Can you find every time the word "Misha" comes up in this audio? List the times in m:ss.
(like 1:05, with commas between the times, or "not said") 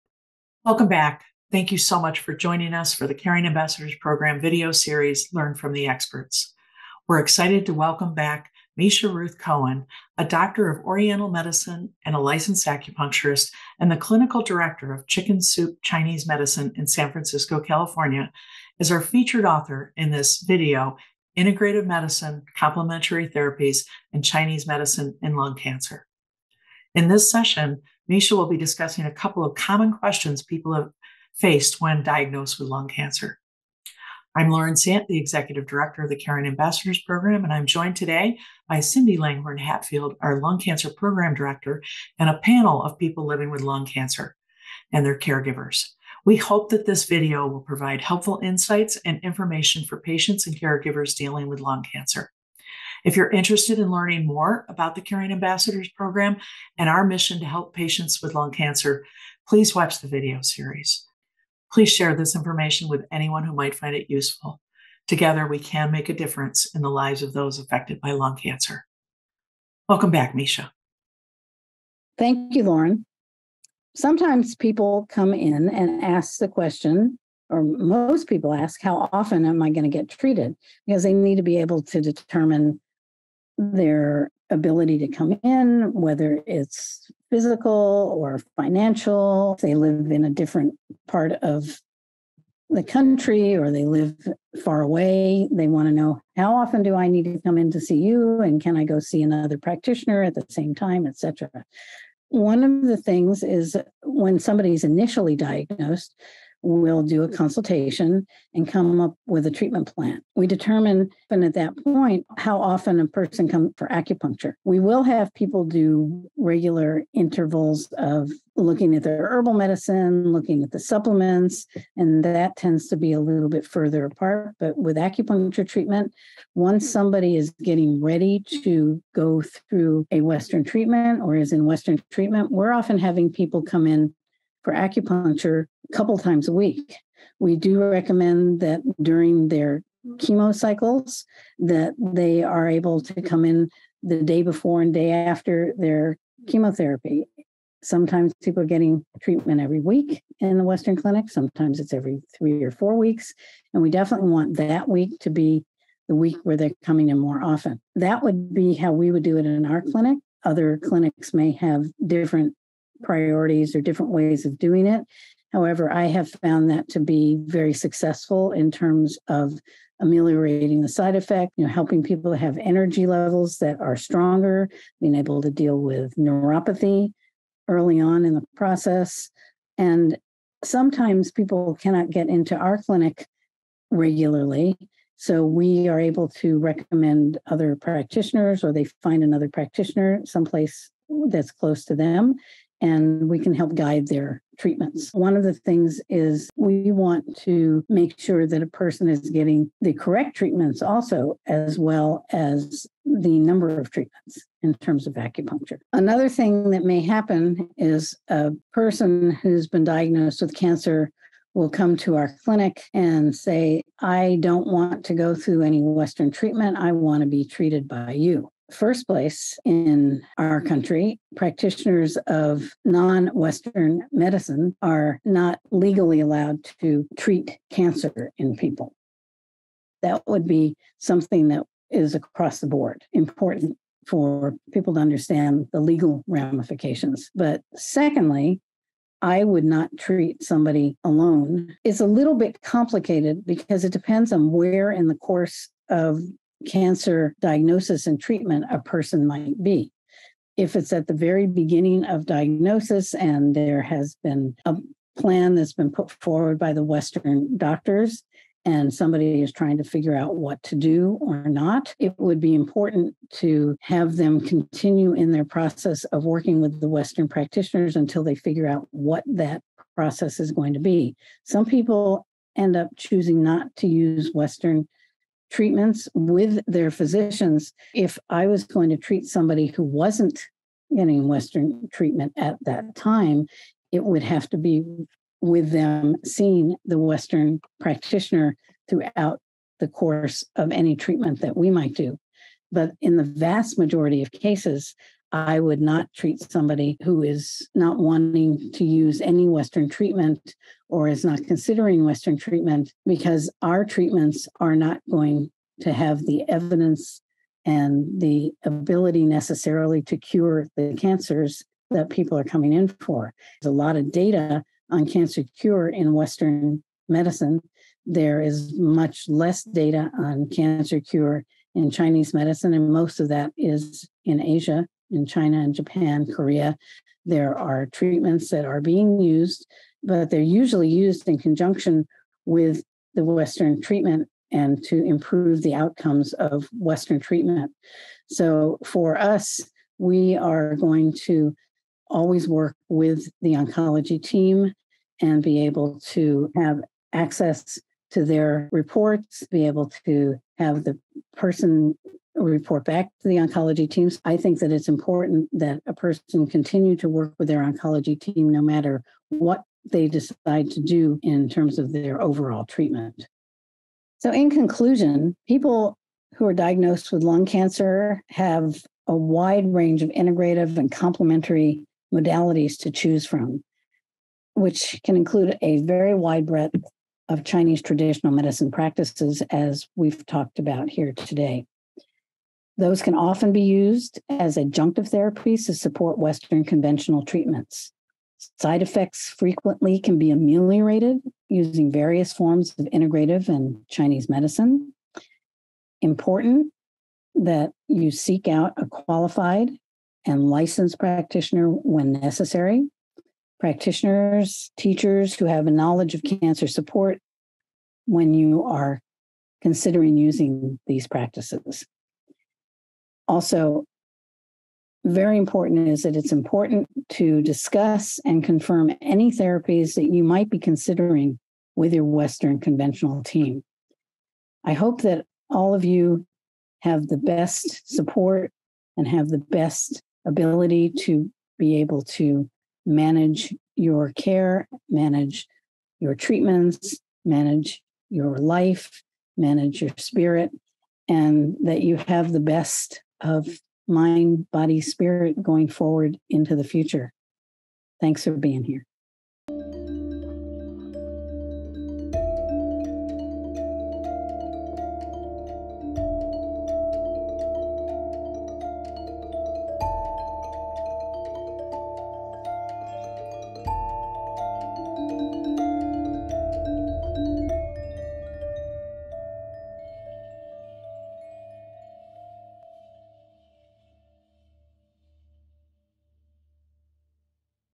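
0:08, 0:28, 1:10.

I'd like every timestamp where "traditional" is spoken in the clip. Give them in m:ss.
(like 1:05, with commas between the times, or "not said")
6:17.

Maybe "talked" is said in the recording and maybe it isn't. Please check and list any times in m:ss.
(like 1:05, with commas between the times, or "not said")
6:20.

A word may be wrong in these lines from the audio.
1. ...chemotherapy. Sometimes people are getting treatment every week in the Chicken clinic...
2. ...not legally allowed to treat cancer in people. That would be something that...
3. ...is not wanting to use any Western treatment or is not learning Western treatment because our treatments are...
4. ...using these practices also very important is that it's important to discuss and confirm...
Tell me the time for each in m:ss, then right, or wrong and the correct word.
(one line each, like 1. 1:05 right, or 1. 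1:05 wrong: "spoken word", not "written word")
1. 2:26 wrong: "Western", not "Chicken"
2. 3:45 right
3. 4:57 wrong: "considering", not "learning"
4. 6:50 right.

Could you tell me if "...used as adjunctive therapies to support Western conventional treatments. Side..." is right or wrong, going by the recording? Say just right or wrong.
right.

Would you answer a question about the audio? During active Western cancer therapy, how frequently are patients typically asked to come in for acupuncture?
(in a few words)
a couple times a week.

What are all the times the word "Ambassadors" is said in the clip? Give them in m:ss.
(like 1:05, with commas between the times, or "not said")
0:03, 0:36, 0:55.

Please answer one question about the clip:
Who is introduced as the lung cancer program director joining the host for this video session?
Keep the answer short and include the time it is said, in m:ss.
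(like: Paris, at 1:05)
Cindy Langhorn Hatfield, at 0:38.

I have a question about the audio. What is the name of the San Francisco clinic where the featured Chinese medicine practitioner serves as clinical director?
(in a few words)
Chicken Soup Chinese Medicine.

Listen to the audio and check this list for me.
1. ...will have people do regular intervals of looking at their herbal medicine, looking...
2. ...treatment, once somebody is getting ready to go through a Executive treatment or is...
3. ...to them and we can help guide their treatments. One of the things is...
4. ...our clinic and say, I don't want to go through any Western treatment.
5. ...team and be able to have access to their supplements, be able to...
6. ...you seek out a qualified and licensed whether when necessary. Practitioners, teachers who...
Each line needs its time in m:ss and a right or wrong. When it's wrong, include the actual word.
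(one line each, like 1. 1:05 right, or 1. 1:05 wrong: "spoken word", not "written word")
1. 1:54 right
2. 2:05 wrong: "Western", not "Executive"
3. 3:11 right
4. 3:32 right
5. 5:44 wrong: "reports", not "supplements"
6. 6:37 wrong: "practitioner", not "whether".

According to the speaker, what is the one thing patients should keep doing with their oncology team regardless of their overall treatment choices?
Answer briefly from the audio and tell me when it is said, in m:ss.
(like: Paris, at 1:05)
continue to work with their oncology team, at 5:56.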